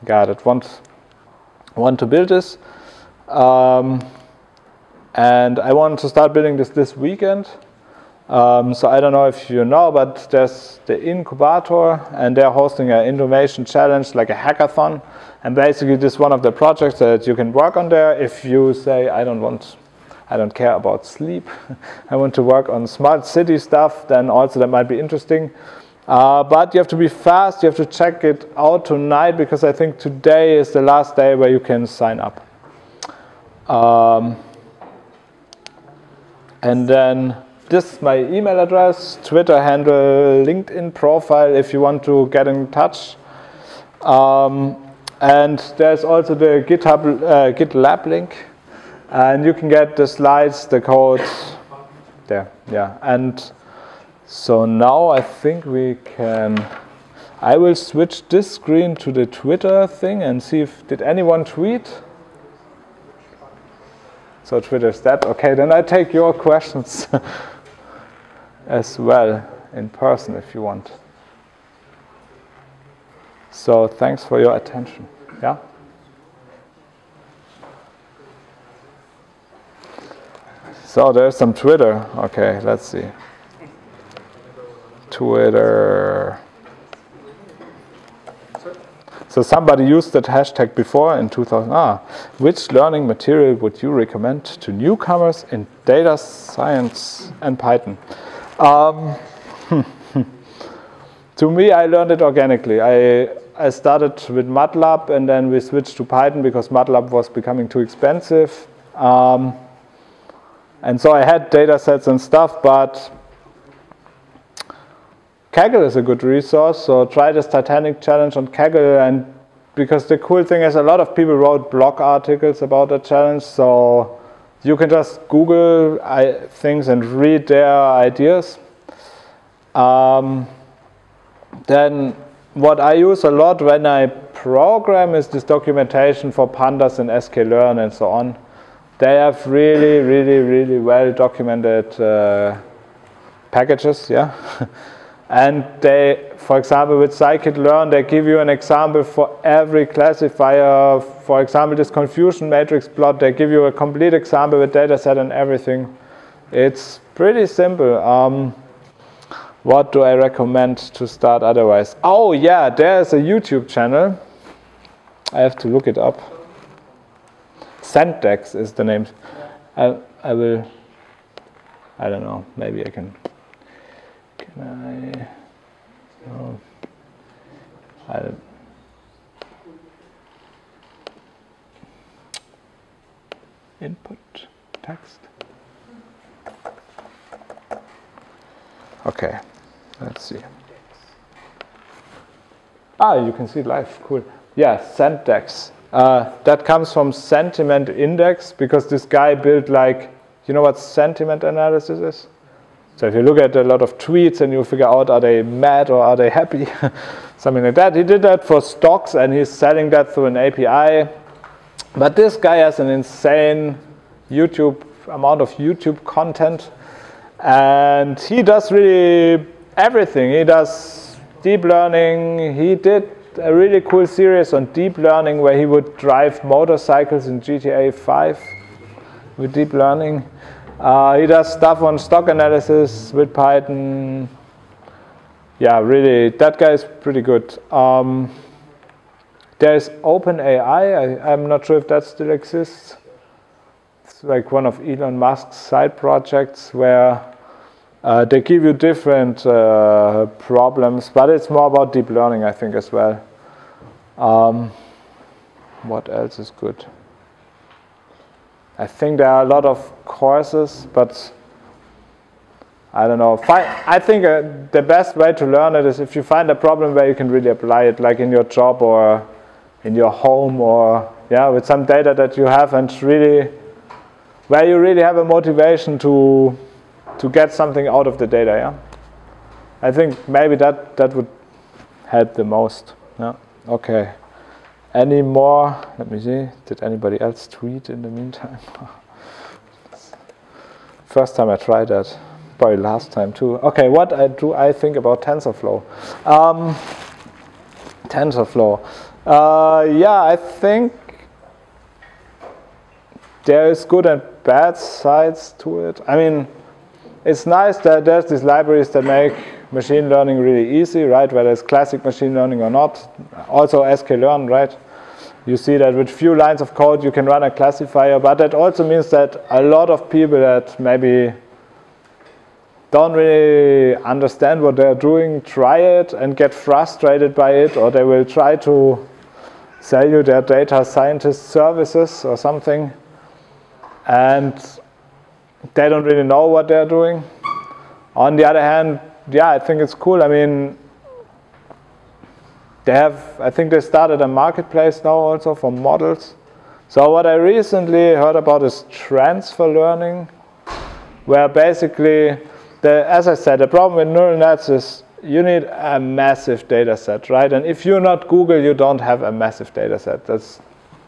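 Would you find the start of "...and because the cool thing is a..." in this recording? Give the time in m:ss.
1:59.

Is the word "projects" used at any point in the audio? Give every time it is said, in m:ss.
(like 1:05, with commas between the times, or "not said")
0:16, 4:05.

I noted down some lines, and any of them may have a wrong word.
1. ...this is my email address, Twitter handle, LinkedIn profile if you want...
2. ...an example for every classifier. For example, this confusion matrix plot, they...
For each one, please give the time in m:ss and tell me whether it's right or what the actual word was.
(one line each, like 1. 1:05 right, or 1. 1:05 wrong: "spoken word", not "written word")
1. 0:37 right
2. 2:28 right.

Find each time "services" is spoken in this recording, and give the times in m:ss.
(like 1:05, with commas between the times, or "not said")
5:31.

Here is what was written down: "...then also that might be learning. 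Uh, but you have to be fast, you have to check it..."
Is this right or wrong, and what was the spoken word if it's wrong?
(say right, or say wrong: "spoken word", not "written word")
wrong: "interesting", not "learning".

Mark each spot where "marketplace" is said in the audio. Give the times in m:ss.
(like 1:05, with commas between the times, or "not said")
5:44.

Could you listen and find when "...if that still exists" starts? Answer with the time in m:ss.
4:01.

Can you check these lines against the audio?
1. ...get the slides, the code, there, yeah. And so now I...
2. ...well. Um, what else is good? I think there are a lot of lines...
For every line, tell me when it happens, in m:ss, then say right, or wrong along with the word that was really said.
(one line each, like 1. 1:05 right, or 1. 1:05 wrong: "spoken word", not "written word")
1. 0:49 right
2. 4:12 wrong: "courses", not "lines".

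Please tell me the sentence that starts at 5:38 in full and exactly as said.
On the other hand, yeah, I think it's cool.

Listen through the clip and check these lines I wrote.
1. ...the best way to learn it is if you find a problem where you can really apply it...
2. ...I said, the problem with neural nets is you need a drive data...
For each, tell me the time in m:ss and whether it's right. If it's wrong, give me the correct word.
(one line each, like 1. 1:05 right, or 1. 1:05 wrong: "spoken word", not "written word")
1. 4:24 right
2. 5:53 wrong: "massive", not "drive".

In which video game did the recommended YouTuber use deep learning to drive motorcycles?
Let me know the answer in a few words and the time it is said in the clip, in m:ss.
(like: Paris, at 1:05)
GTA 5, at 3:47.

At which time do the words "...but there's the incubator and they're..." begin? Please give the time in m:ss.
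0:09.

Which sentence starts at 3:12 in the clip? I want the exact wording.
Ah, you can see live, cool.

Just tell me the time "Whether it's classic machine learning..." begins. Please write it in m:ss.
5:11.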